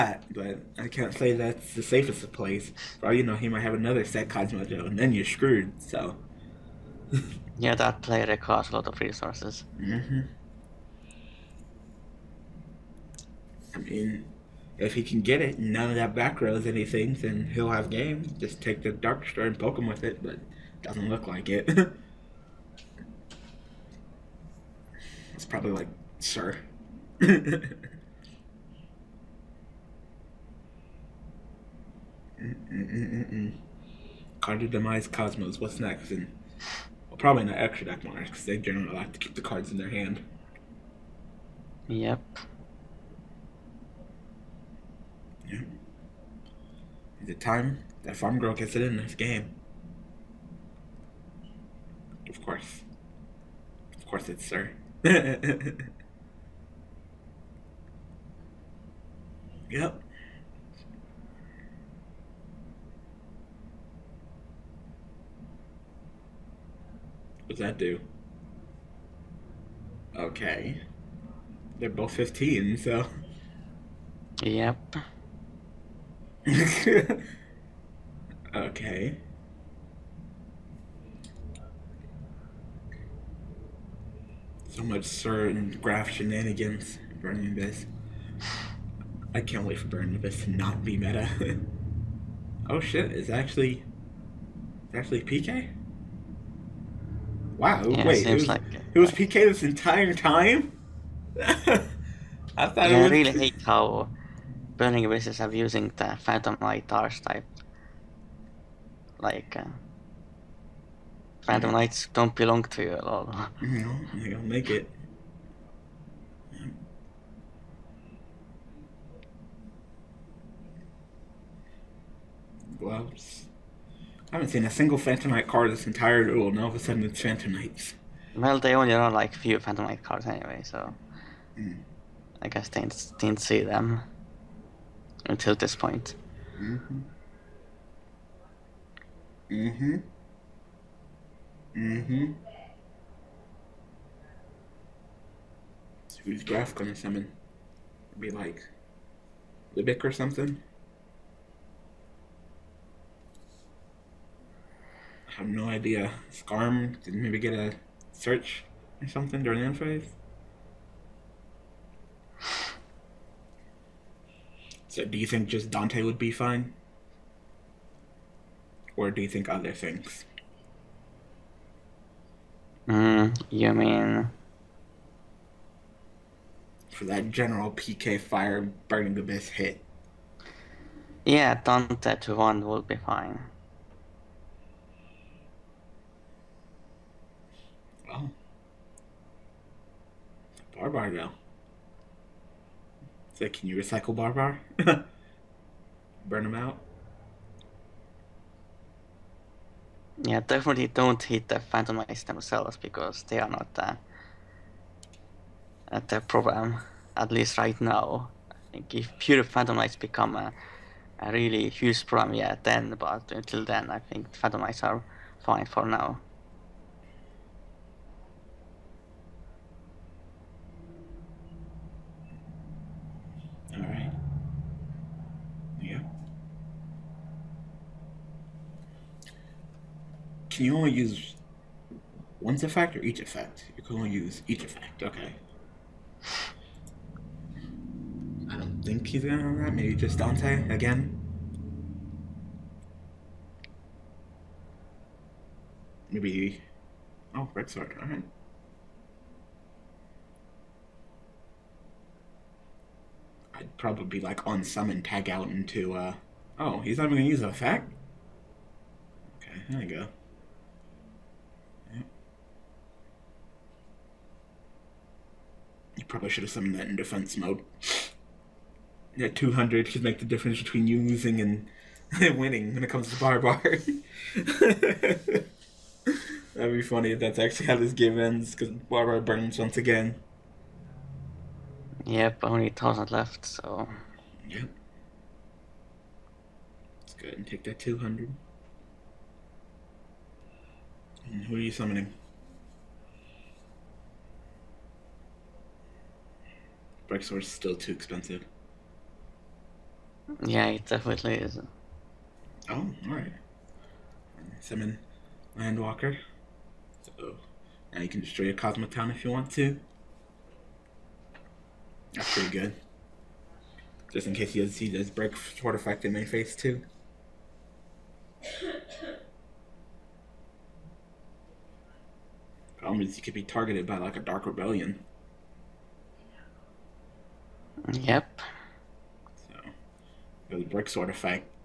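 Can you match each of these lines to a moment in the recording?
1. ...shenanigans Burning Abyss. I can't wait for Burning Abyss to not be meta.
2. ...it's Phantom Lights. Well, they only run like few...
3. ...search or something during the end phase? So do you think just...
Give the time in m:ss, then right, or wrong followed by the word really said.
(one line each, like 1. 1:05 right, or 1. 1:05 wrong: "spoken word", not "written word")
1. 1:26 right
2. 2:07 right
3. 2:38 right.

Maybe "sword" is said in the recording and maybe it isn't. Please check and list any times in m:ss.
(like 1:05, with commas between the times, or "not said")
4:07.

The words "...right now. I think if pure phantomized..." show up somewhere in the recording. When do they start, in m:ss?
3:27.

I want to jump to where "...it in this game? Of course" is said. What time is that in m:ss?
0:48.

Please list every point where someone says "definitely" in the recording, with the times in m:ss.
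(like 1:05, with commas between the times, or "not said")
3:20, 5:00.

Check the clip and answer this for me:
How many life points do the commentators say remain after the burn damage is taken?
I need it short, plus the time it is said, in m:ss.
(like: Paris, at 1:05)
1,000, at 4:42.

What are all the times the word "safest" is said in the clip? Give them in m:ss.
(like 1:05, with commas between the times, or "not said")
0:01.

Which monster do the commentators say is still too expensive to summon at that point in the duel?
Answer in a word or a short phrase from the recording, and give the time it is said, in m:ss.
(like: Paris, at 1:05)
Grexor, at 4:57.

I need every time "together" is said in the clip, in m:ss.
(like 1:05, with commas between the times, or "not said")
not said.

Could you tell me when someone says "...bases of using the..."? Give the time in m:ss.
1:45.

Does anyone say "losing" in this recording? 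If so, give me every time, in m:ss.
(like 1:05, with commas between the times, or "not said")
4:30.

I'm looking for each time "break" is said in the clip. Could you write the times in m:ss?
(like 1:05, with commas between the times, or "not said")
5:15.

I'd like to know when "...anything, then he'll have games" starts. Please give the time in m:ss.
0:16.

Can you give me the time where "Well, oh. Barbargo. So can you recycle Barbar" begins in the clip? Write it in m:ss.
3:08.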